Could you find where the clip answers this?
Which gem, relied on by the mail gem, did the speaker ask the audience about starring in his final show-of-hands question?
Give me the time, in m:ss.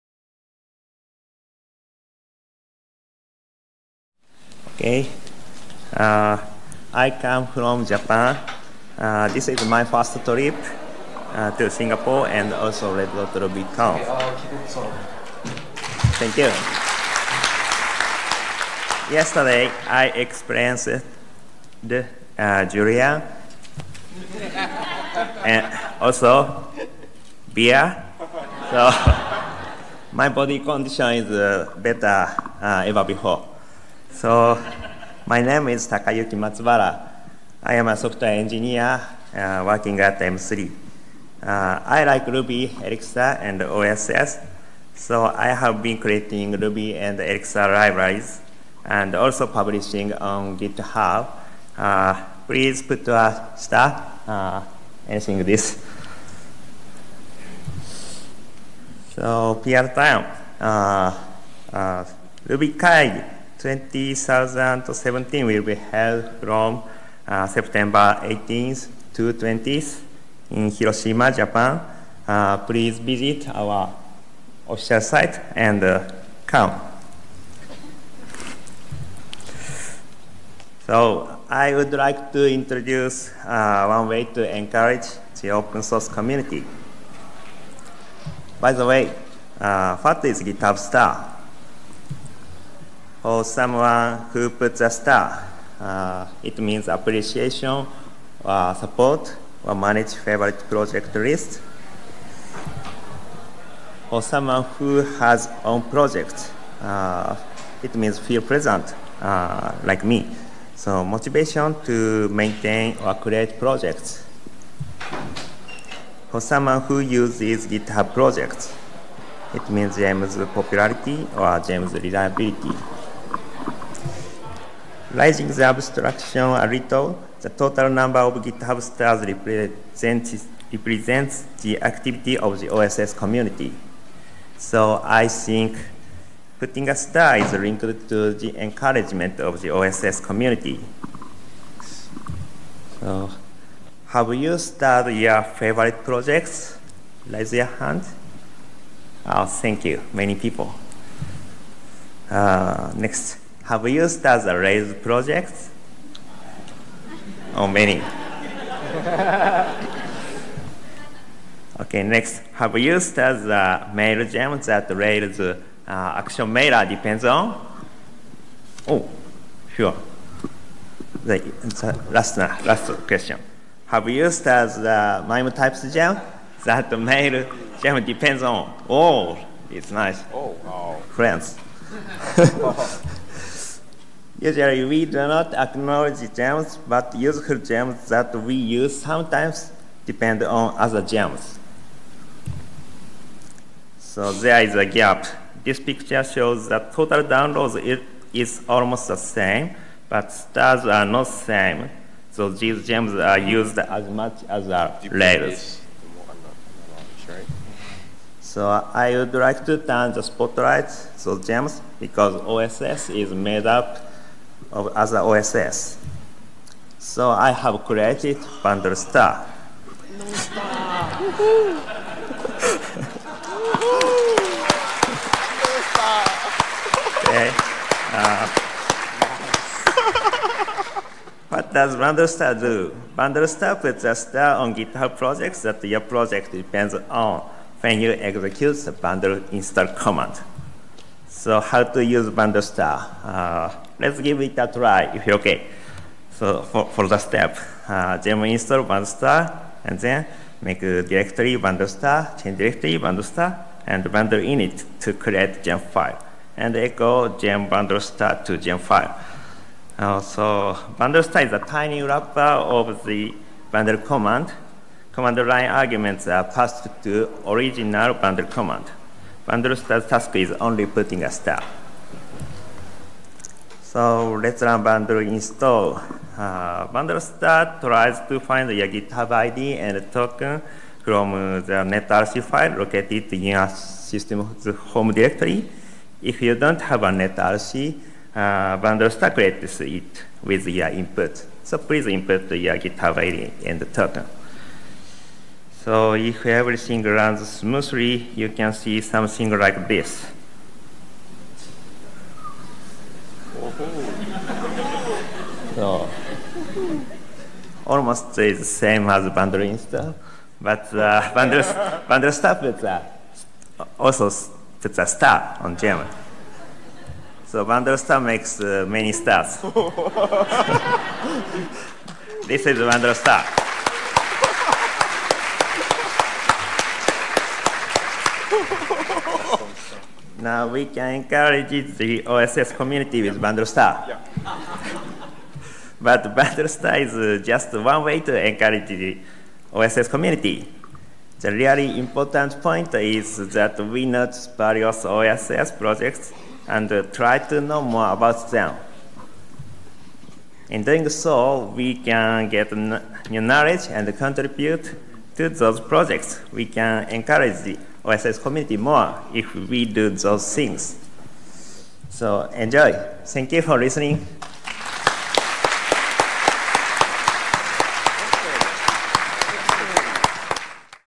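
2:55.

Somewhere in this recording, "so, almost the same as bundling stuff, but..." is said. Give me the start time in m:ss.
5:05.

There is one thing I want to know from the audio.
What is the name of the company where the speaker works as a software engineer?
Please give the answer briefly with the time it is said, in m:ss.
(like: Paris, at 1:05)
M3, at 0:40.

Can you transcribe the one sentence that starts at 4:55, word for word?
So if everything runs smoothly, you can see something like this.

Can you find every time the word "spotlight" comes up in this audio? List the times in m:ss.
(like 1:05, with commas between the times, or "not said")
3:30.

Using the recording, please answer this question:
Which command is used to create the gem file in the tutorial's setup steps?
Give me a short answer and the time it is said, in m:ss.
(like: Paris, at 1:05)
bundle init, at 4:14.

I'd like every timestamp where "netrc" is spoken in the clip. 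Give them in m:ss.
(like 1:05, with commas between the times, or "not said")
4:41, 4:47.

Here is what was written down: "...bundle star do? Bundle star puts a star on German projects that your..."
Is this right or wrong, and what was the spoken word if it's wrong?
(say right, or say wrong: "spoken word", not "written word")
wrong: "GitHub", not "German".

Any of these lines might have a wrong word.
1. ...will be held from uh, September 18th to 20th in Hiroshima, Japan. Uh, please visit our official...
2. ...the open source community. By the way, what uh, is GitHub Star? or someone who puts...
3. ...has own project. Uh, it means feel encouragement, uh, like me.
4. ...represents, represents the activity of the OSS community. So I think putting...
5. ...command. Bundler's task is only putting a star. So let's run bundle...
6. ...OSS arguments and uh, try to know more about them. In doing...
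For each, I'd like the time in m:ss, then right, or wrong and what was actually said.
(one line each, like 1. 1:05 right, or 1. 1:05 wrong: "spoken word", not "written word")
1. 1:05 right
2. 1:25 right
3. 1:45 wrong: "present", not "encouragement"
4. 2:09 right
5. 4:28 right
6. 5:45 wrong: "projects", not "arguments".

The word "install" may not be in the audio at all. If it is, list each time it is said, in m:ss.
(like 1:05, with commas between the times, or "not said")
3:59, 4:08, 4:35.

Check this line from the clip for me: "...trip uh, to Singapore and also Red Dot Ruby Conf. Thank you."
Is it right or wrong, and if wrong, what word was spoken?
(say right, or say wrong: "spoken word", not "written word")
right.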